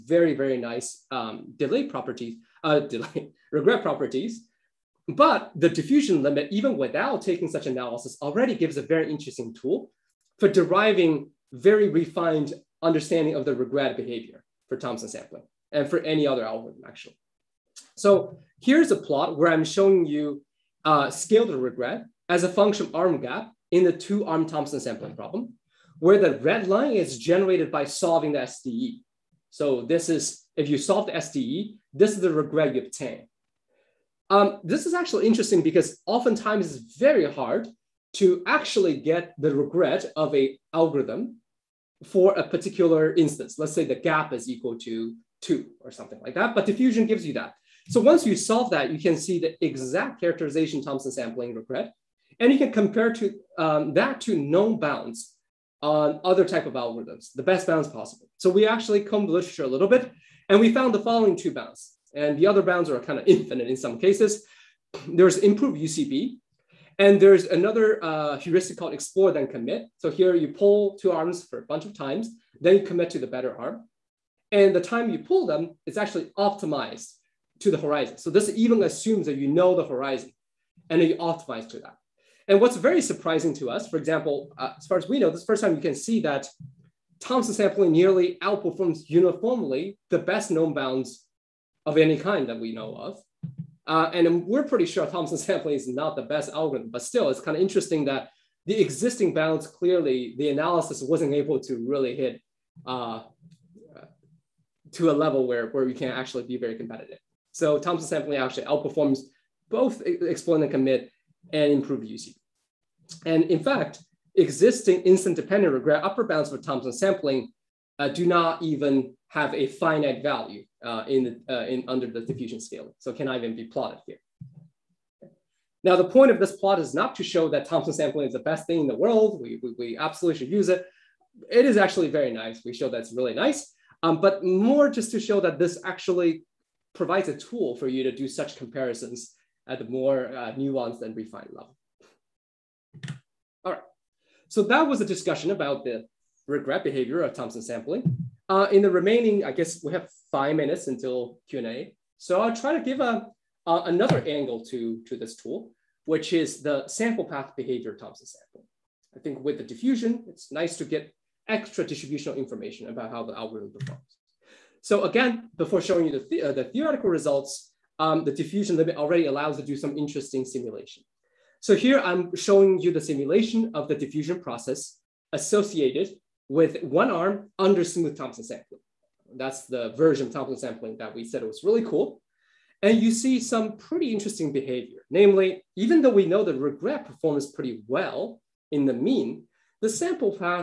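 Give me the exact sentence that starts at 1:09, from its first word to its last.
So here you pull two arms for a bunch of times, then you commit to the better arm.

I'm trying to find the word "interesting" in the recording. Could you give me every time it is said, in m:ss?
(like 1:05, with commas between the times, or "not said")
0:09, 0:35, 1:37, 2:49, 3:04.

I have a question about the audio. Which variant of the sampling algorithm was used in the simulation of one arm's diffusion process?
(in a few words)
Smooth Thompson sampling.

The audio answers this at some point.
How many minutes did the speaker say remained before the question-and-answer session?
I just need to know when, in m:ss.
2:30.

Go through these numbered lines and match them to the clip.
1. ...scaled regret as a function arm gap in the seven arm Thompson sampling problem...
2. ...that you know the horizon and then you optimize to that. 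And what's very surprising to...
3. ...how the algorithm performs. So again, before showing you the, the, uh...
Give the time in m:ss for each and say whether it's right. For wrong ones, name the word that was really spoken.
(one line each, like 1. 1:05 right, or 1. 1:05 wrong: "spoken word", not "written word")
1. 0:21 wrong: "two", not "seven"
2. 1:19 right
3. 2:43 right.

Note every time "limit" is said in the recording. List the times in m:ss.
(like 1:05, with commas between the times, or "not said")
0:06, 2:48.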